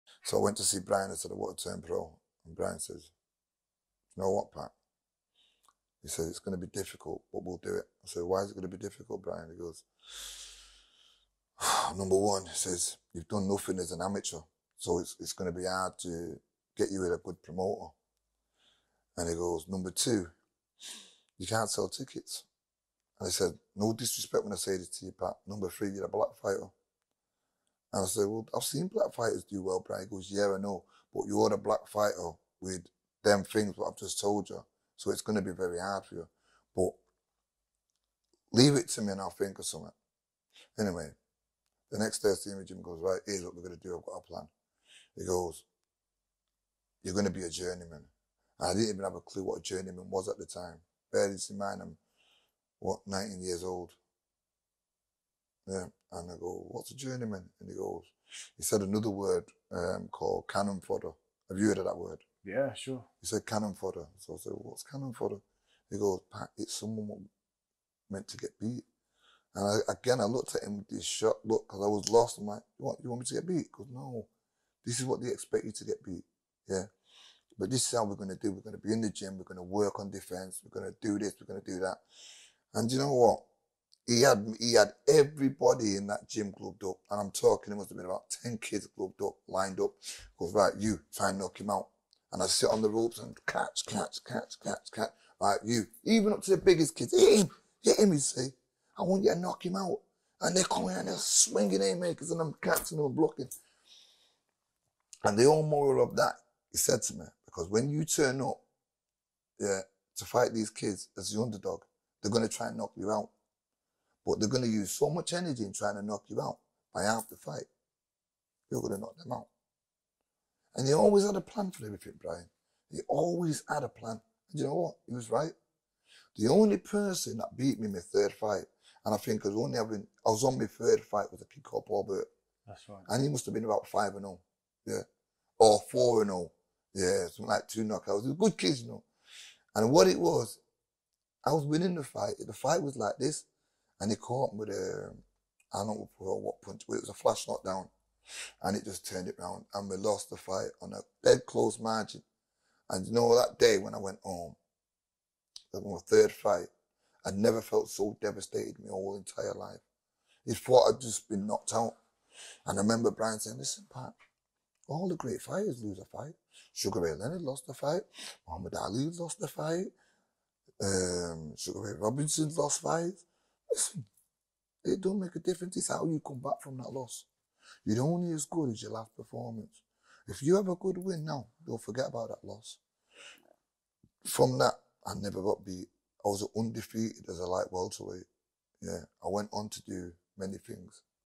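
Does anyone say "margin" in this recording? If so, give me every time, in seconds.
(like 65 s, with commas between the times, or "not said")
151 s.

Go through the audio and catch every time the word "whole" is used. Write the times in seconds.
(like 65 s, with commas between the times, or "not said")
105 s, 158 s.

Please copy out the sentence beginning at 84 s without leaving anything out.
He had he had everybody in that gym clubbed up, and I'm talking.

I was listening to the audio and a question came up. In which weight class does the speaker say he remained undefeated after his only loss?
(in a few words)
light welterweight.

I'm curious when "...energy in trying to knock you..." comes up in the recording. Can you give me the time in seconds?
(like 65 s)
115 s.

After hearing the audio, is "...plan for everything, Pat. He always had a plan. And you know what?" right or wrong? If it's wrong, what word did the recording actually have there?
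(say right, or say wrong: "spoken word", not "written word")
wrong: "Brian", not "Pat".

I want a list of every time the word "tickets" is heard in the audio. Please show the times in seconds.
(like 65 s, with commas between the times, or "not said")
21 s.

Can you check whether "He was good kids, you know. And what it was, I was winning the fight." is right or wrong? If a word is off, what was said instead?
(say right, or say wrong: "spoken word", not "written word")
right.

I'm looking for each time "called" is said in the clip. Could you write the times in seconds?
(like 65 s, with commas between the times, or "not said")
60 s, 131 s.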